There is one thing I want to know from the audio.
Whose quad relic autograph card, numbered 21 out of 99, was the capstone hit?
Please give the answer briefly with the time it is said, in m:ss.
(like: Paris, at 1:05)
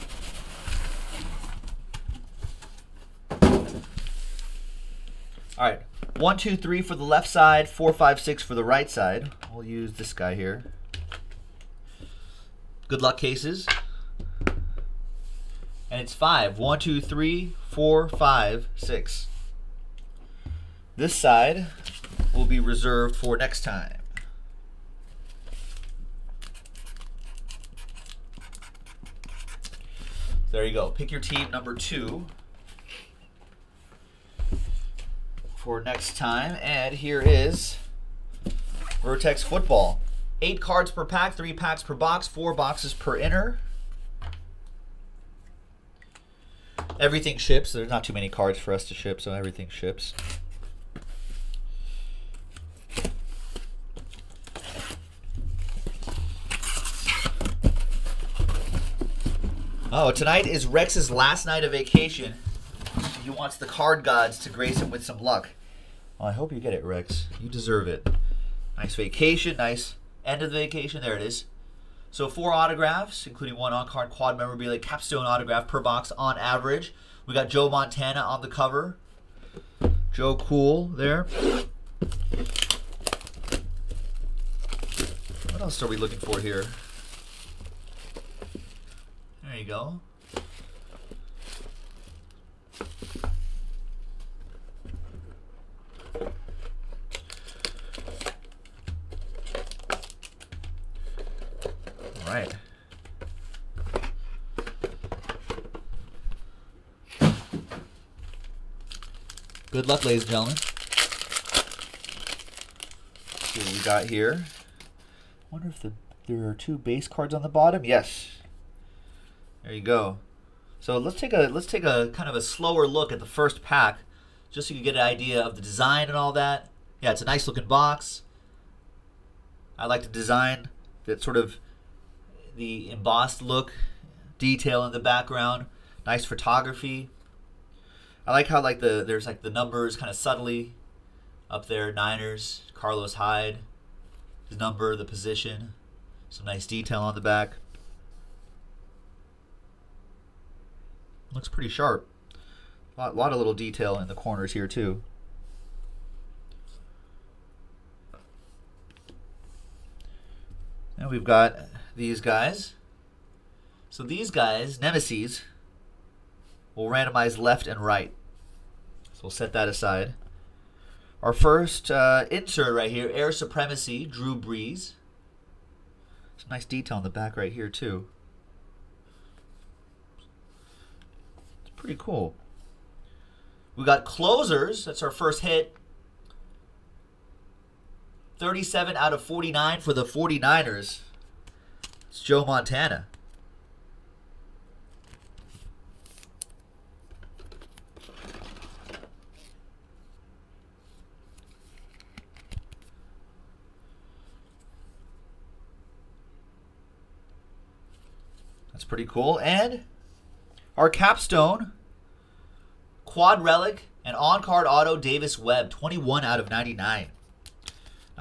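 Davis Webb, at 3:34.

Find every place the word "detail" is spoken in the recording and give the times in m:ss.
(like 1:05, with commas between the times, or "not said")
2:14, 2:26, 2:33, 2:56.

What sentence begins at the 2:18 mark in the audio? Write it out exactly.
I like how like the there's like the numbers kind of subtly up there.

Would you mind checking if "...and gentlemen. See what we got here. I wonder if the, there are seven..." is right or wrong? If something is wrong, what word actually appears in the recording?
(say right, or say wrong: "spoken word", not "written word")
wrong: "two", not "seven".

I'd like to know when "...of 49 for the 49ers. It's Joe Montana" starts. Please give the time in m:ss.
3:09.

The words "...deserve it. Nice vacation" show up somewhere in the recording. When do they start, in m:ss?
1:07.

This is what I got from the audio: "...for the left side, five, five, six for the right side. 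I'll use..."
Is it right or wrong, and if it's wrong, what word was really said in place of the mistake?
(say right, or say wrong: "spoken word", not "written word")
wrong: "four", not "five".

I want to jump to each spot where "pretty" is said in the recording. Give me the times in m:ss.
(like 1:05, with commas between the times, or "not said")
2:31, 3:01, 3:28.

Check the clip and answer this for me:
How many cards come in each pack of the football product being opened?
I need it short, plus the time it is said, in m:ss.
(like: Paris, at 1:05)
8, at 0:40.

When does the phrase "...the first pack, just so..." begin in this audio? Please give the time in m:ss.
2:03.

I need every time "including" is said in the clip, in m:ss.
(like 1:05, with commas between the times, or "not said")
1:13.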